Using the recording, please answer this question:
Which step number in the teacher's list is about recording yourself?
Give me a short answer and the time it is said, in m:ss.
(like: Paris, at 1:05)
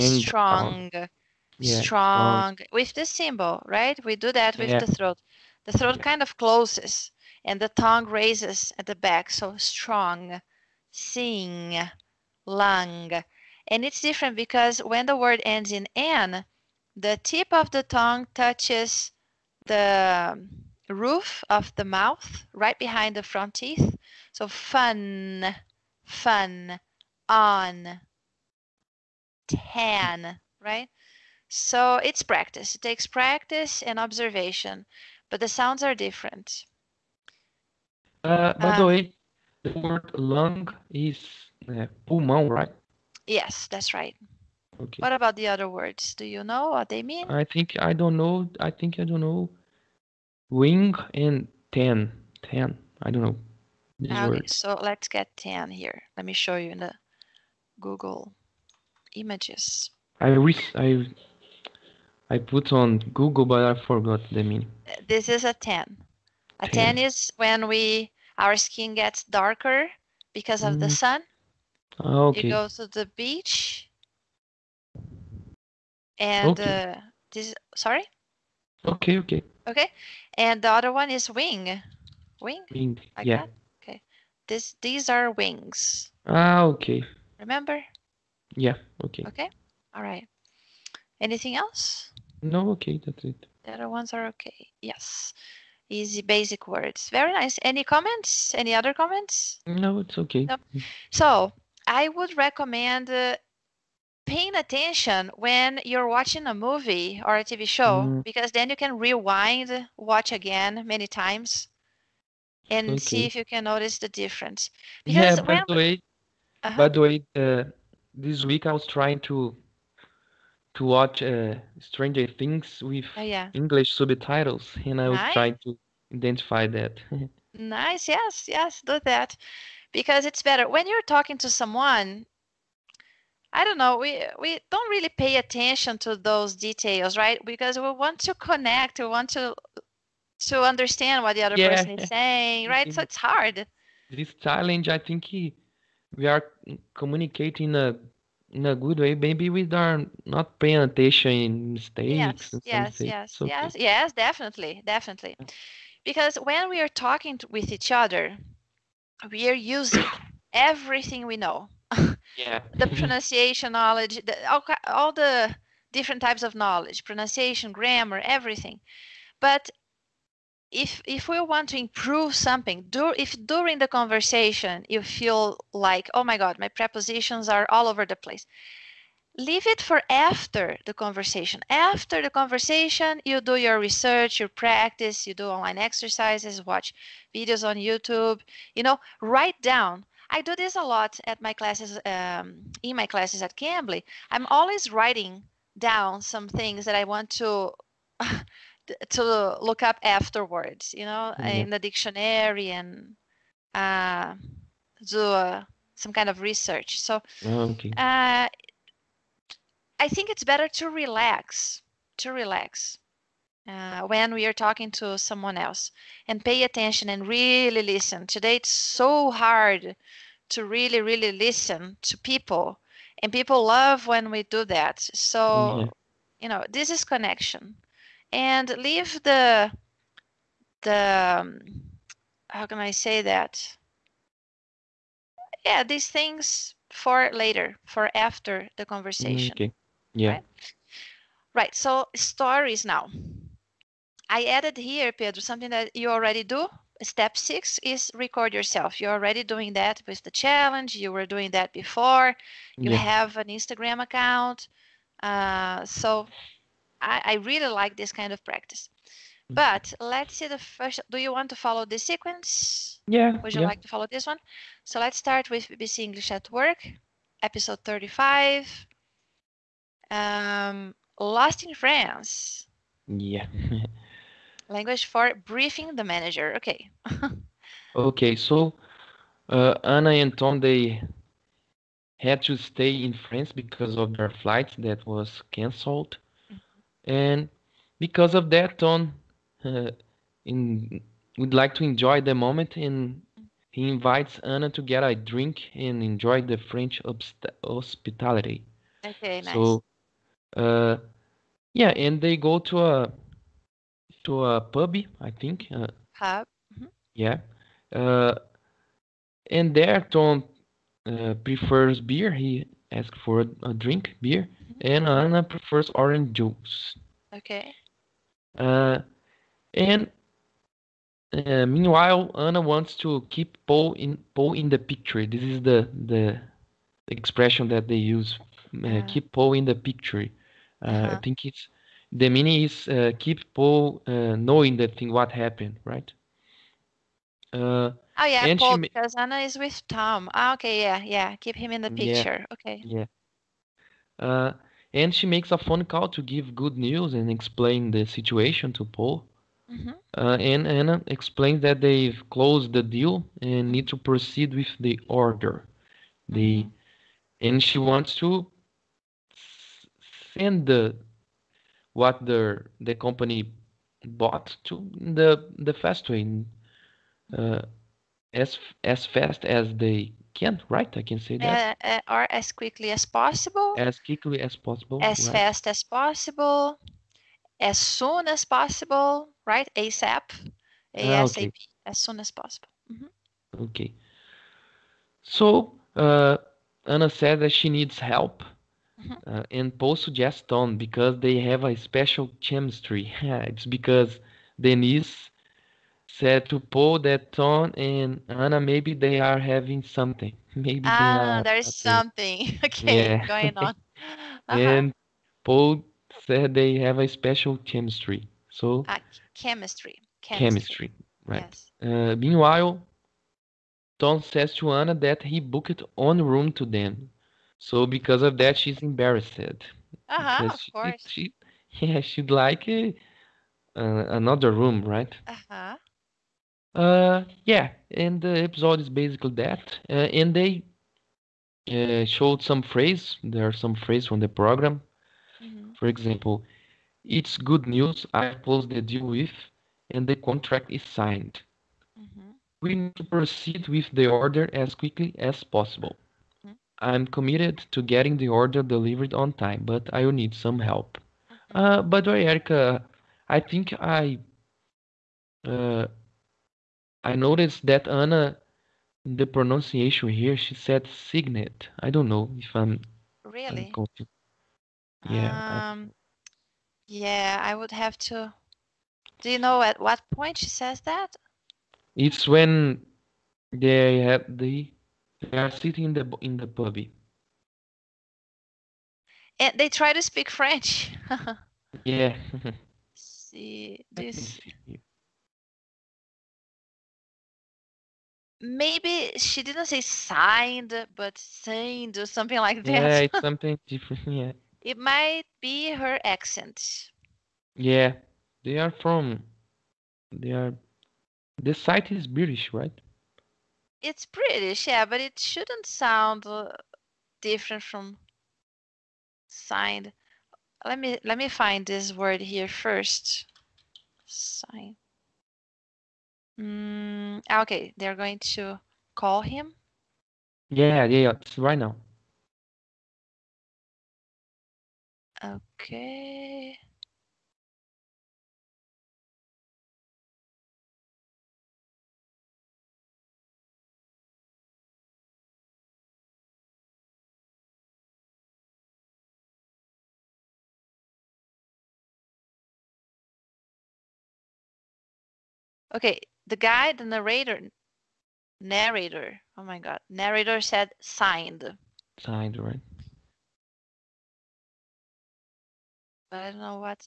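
6, at 4:07.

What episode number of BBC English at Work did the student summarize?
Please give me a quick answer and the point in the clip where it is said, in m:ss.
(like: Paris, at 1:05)
35, at 4:27.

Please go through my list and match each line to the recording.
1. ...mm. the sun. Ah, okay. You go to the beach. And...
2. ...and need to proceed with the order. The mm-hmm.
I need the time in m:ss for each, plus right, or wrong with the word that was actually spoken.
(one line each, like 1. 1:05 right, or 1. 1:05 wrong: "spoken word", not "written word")
1. 1:10 right
2. 5:53 right.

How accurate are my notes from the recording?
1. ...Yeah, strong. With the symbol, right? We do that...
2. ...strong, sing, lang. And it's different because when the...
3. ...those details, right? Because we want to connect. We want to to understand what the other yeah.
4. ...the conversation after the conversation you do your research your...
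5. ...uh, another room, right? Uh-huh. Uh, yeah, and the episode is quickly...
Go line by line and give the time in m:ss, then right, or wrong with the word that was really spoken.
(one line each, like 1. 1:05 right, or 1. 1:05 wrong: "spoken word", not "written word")
1. 0:01 right
2. 0:09 right
3. 2:16 right
4. 3:00 right
5. 7:02 wrong: "basically", not "quickly".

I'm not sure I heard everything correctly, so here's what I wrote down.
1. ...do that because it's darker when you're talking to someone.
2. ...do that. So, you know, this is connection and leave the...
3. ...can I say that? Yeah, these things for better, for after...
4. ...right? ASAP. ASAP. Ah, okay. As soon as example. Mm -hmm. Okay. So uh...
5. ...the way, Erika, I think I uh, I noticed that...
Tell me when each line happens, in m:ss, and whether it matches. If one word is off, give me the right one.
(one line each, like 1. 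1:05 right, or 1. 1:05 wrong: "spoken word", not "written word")
1. 2:08 wrong: "better", not "darker"
2. 3:44 right
3. 3:52 wrong: "later", not "better"
4. 6:19 wrong: "possible", not "example"
5. 7:32 right.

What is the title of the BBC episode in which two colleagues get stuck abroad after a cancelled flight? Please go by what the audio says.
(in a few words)
Lost in France.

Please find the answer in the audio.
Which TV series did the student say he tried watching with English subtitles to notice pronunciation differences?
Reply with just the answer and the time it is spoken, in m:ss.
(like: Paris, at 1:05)
Stranger Things, at 2:01.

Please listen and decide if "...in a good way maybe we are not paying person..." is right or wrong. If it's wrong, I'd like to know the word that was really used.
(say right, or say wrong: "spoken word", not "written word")
wrong: "attention", not "person".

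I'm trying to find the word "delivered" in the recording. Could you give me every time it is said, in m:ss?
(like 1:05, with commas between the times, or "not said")
7:28.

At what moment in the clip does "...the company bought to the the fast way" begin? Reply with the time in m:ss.
6:02.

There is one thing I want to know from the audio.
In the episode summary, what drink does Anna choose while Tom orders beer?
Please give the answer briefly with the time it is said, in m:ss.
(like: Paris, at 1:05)
orange juice, at 5:15.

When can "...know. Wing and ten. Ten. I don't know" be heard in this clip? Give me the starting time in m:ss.
0:49.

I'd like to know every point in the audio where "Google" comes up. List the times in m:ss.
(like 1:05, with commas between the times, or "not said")
0:57, 1:03.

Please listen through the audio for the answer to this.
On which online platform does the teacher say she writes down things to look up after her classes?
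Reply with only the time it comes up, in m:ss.
3:13.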